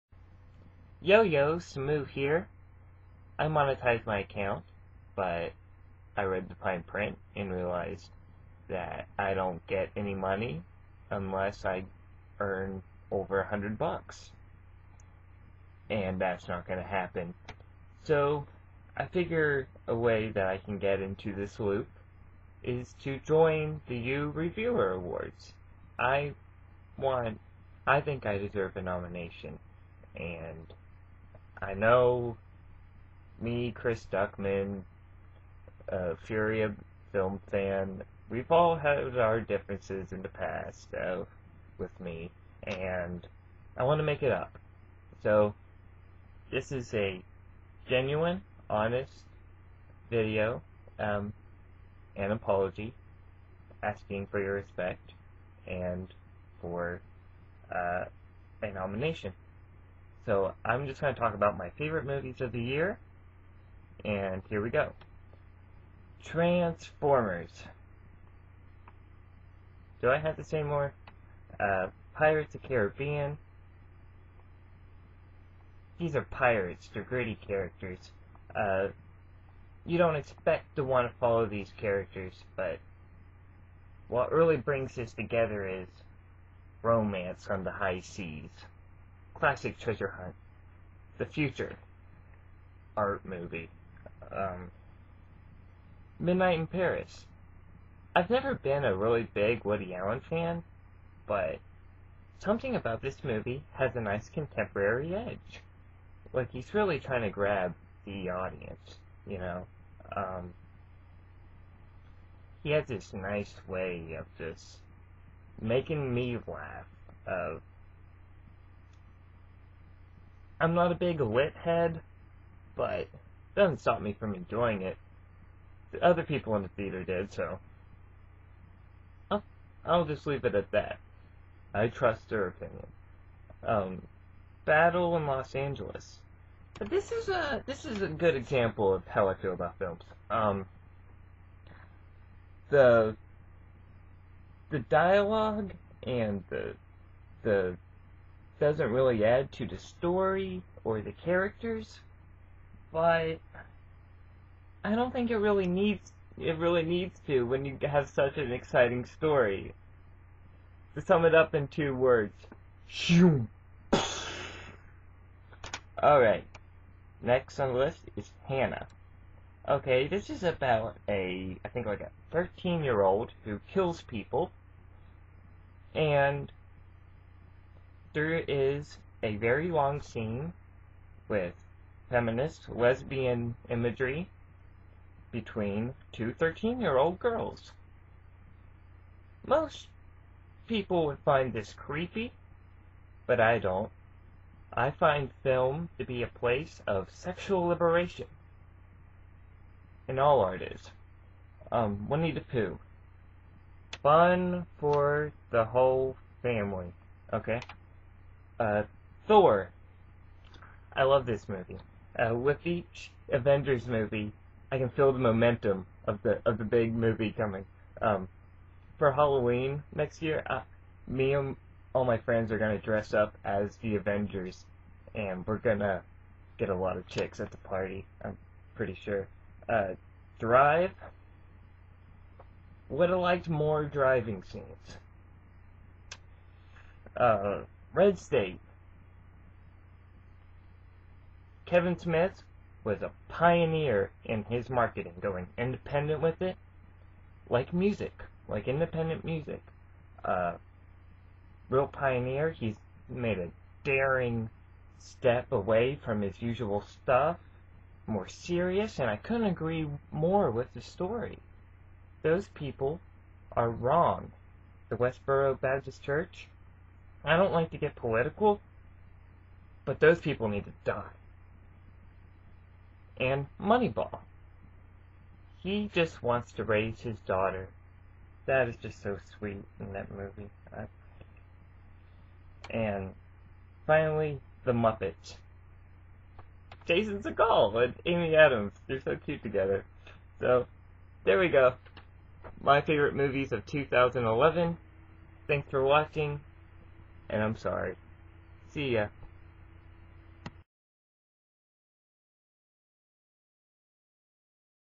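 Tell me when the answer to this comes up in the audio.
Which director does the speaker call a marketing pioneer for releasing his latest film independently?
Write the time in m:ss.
4:01.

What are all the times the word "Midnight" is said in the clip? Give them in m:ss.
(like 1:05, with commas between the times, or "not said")
1:36.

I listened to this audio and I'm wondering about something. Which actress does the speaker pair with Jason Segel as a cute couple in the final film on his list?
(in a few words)
Amy Adams.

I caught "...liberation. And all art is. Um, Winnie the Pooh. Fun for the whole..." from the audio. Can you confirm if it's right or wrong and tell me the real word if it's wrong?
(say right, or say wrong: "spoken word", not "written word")
right.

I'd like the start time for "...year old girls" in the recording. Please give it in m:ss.
3:06.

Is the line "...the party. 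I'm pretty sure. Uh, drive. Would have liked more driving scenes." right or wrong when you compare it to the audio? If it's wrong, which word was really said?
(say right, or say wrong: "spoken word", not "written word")
right.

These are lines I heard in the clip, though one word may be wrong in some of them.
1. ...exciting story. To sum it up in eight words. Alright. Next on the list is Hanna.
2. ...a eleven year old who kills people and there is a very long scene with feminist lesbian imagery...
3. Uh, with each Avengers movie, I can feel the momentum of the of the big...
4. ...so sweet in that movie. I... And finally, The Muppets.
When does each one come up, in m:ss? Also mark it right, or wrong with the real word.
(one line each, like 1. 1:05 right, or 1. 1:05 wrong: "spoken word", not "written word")
1. 2:38 wrong: "two", not "eight"
2. 2:52 wrong: "thirteen", not "eleven"
3. 3:32 right
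4. 4:39 right.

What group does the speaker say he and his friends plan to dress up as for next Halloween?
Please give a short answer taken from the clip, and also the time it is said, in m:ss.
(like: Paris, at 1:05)
The Avengers, at 3:43.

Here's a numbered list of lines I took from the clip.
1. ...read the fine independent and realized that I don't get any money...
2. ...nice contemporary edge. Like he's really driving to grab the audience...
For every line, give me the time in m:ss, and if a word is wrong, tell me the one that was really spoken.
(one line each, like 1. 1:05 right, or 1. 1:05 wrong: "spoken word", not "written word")
1. 0:06 wrong: "print", not "independent"
2. 1:44 wrong: "trying", not "driving".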